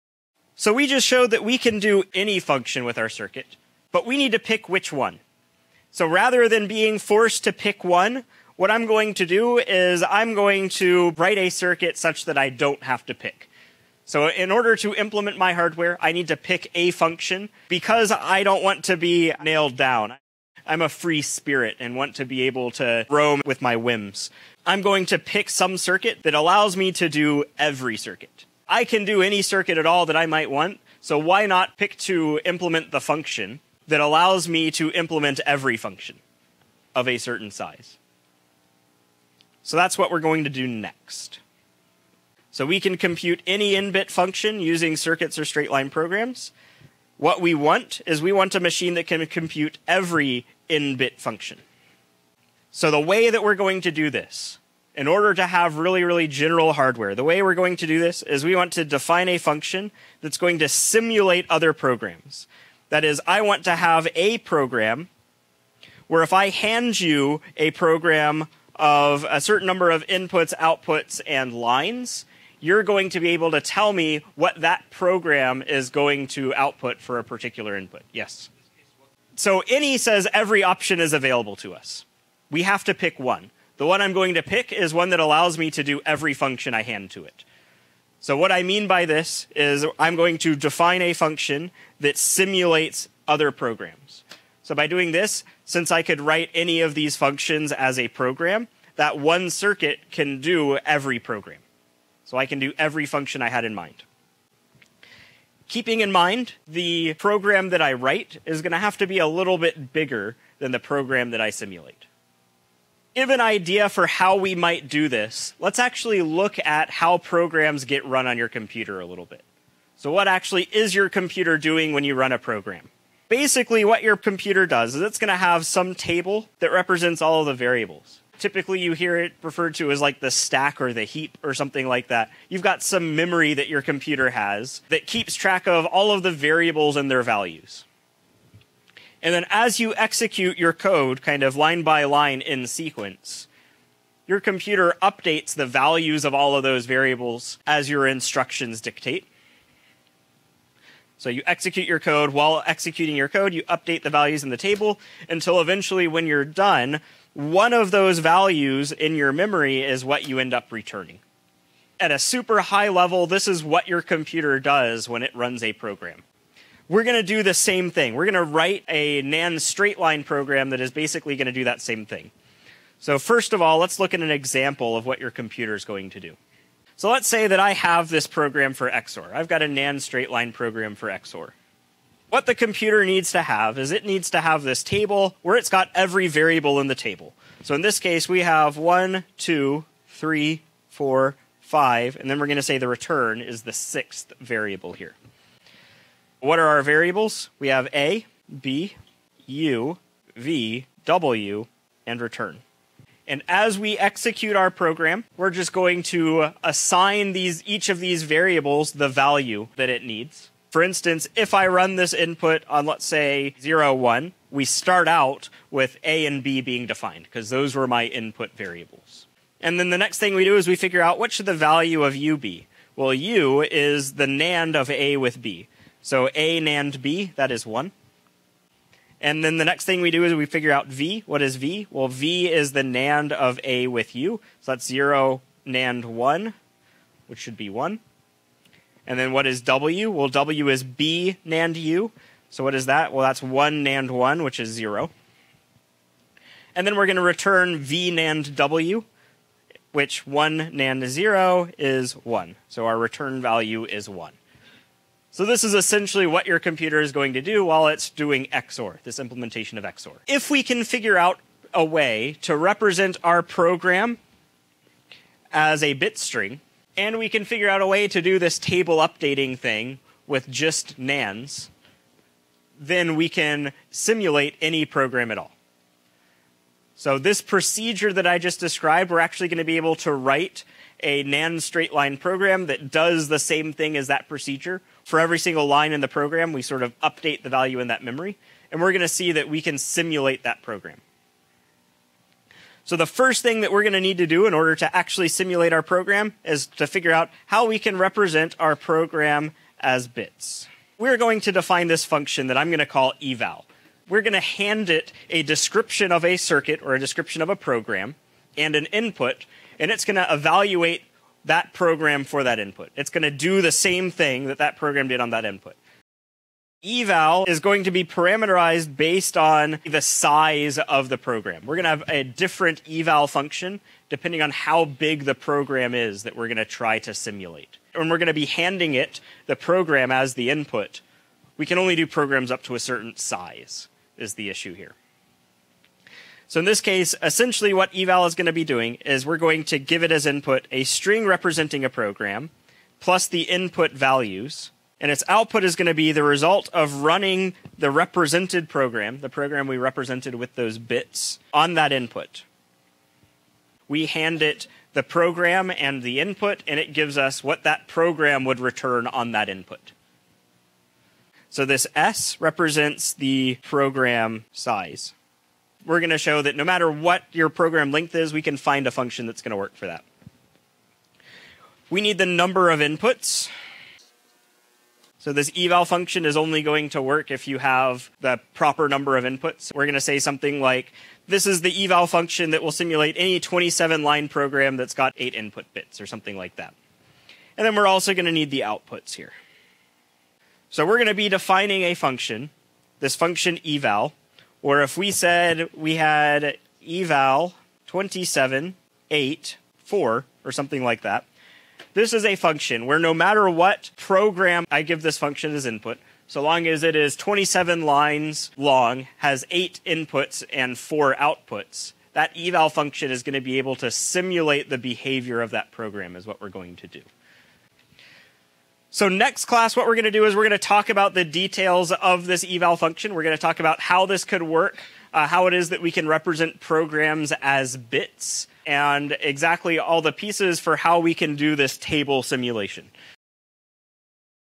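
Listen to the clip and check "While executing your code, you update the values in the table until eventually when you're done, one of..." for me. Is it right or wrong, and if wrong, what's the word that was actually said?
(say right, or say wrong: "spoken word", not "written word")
right.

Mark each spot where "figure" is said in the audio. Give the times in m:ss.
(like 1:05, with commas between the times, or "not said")
3:40, 3:50, 4:20, 4:27, 4:56.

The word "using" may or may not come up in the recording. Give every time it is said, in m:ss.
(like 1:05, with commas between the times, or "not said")
0:44.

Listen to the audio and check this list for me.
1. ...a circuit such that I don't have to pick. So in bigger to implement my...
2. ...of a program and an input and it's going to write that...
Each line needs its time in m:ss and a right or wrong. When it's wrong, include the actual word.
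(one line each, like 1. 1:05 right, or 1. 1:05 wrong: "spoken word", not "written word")
1. 0:11 wrong: "order", not "bigger"
2. 5:07 wrong: "evaluate", not "write".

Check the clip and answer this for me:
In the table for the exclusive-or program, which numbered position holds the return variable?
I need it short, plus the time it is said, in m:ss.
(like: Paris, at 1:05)
sixth, at 3:13.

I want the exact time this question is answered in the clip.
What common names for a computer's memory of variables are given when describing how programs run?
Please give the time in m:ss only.
2:10.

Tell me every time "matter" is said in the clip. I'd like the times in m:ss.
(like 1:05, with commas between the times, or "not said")
6:06, 6:43.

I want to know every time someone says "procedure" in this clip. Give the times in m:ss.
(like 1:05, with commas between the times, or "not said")
4:37, 4:44.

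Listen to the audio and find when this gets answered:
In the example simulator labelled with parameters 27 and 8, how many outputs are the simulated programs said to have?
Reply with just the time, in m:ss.
6:50.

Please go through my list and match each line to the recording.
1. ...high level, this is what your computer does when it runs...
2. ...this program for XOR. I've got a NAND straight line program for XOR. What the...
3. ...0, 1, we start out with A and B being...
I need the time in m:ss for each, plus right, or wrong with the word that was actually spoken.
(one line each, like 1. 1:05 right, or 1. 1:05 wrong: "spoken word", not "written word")
1. 2:42 right
2. 2:58 right
3. 3:33 right.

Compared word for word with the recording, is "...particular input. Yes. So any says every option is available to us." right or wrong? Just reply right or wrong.
right.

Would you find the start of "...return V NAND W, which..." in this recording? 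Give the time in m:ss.
4:07.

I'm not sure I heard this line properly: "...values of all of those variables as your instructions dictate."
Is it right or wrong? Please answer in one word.
right.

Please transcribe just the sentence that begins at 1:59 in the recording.
So what actually is your computer doing when you run a program?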